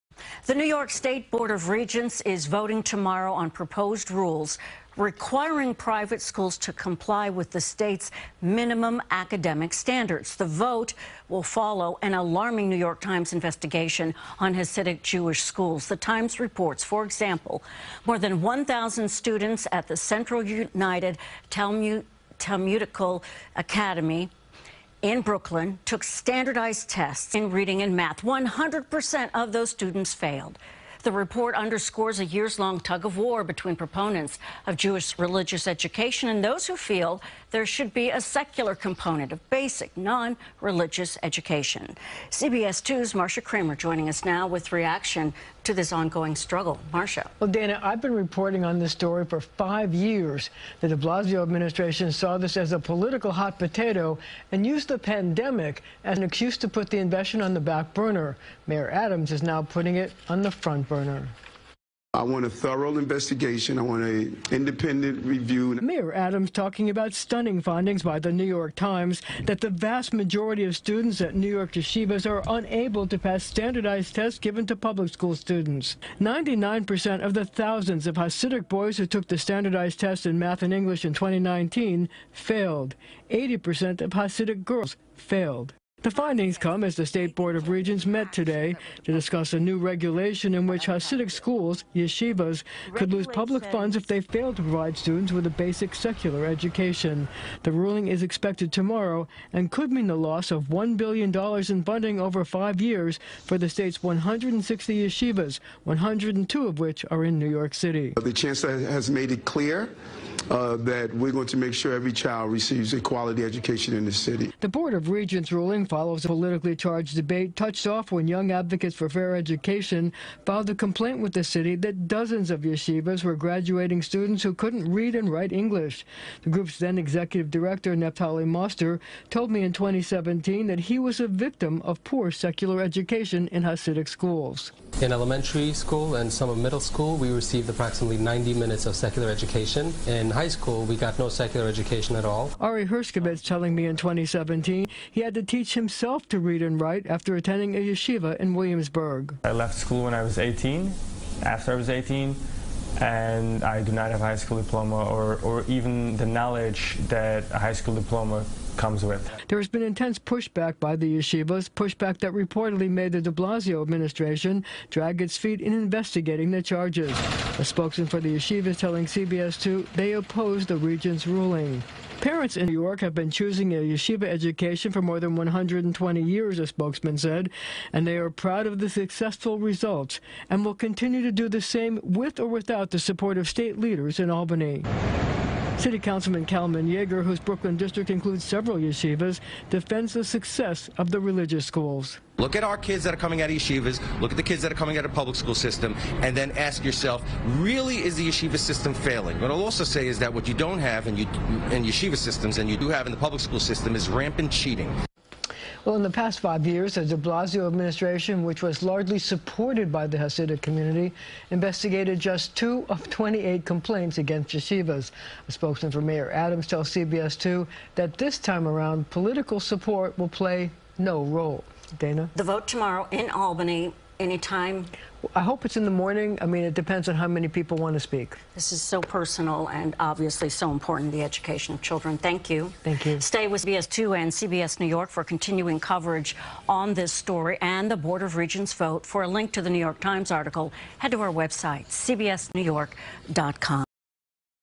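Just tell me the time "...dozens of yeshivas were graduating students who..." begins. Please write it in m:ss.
2:02.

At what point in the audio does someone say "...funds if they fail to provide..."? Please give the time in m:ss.
1:33.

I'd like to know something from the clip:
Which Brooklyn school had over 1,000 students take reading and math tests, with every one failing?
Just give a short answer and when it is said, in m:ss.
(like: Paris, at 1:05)
Central United Talmud Talmudical Academy, at 0:19.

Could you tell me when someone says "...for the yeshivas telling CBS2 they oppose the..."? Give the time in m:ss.
2:48.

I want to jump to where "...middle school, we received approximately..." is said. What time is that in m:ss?
2:16.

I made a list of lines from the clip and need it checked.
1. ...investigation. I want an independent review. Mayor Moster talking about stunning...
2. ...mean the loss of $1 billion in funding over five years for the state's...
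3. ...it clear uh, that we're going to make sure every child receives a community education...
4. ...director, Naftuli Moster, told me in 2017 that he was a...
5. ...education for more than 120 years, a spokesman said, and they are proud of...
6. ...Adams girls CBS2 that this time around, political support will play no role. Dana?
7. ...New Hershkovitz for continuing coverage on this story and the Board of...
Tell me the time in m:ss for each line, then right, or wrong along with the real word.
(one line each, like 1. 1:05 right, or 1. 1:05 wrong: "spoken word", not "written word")
1. 1:02 wrong: "Adams", not "Moster"
2. 1:39 right
3. 1:49 wrong: "quality", not "community"
4. 2:07 right
5. 2:54 right
6. 3:36 wrong: "tells", not "girls"
7. 3:54 wrong: "York", not "Hershkovitz".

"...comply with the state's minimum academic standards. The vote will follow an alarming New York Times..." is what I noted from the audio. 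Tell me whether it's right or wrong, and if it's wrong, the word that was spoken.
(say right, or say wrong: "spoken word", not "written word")
right.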